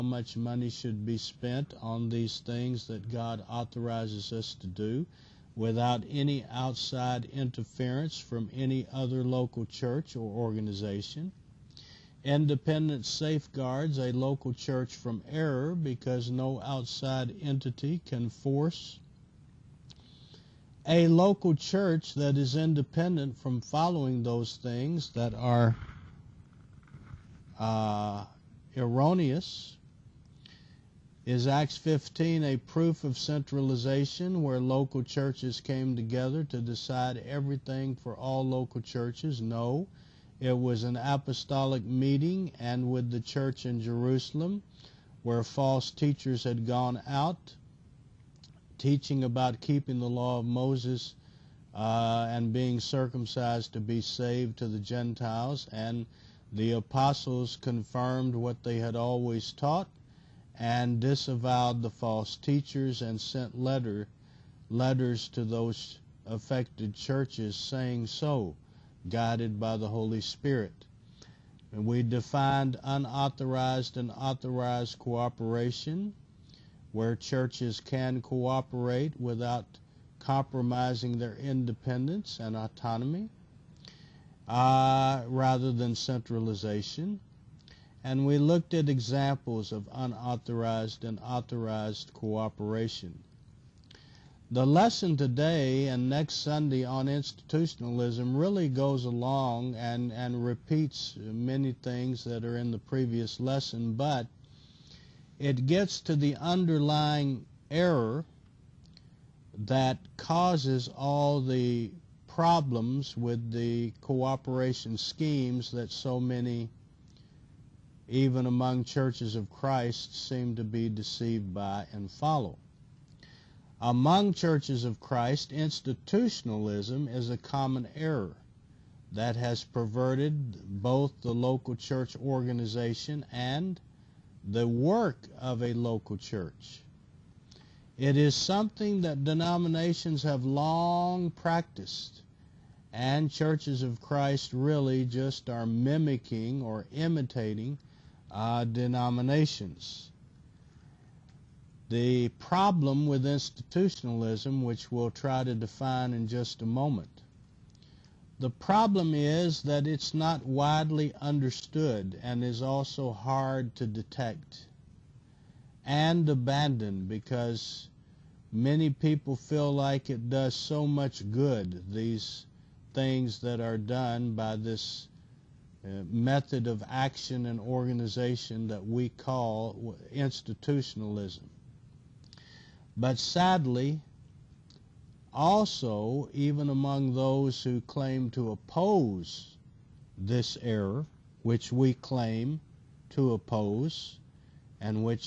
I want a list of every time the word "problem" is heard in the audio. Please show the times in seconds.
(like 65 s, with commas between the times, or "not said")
112 s, 152 s, 158 s.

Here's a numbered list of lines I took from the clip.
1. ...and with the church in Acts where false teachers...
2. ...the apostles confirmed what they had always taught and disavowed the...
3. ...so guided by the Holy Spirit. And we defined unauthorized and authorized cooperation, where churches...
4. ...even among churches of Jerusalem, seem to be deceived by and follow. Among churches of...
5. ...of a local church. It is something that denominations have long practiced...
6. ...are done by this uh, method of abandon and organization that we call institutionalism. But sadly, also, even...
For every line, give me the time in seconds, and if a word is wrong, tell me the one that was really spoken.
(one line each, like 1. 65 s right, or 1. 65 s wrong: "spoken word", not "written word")
1. 42 s wrong: "Jerusalem", not "Acts"
2. 56 s right
3. 68 s right
4. 118 s wrong: "Christ", not "Jerusalem"
5. 135 s right
6. 173 s wrong: "action", not "abandon".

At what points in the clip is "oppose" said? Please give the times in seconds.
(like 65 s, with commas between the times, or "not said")
188 s, 193 s.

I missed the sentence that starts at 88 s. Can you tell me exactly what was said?
And we looked at examples of unauthorized and authorized cooperation.